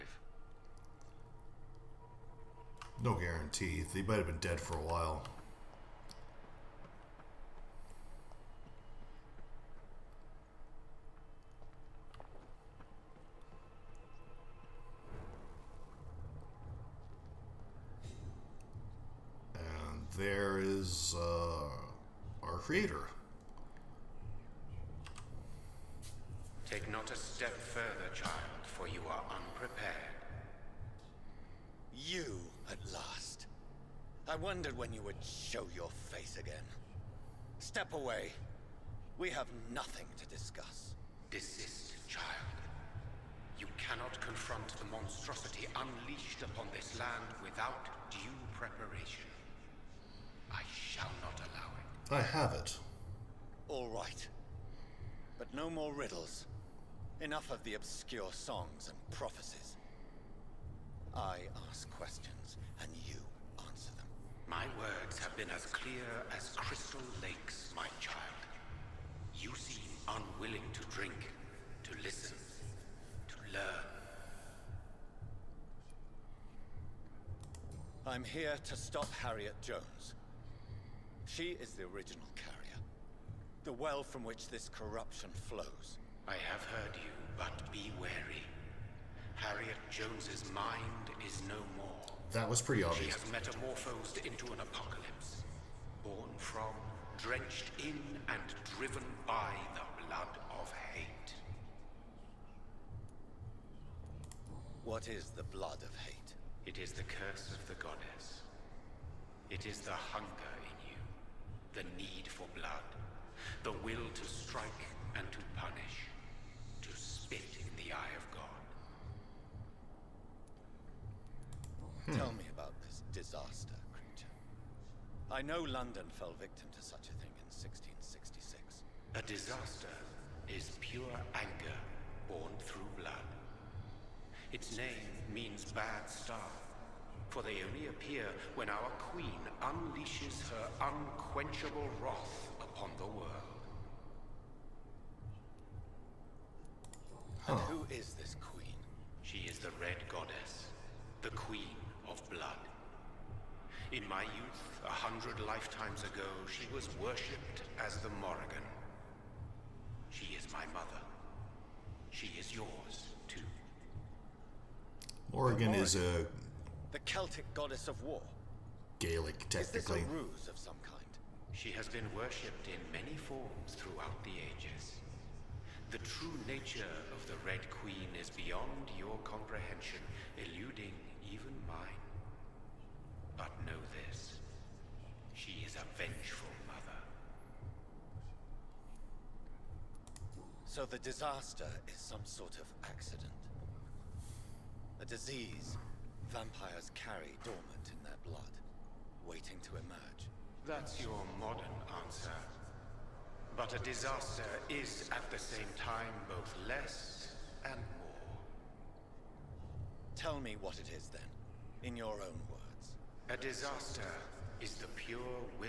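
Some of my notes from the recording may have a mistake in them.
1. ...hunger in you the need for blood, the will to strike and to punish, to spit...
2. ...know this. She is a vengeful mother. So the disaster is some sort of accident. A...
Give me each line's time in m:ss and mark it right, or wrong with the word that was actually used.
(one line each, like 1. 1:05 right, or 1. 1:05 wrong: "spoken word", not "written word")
1. 1:49 right
2. 3:03 right.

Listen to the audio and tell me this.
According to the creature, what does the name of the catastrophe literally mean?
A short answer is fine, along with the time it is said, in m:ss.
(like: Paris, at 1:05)
bad star, at 2:15.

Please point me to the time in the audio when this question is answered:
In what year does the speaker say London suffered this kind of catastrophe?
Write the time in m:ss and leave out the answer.
2:07.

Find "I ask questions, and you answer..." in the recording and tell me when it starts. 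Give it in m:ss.
1:01.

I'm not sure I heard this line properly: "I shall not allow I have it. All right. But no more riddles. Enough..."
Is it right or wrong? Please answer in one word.
right.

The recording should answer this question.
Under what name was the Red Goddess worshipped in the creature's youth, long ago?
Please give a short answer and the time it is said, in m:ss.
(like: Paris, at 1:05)
the Morrigan, at 2:37.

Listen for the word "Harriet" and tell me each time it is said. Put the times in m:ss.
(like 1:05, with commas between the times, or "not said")
1:19, 1:29.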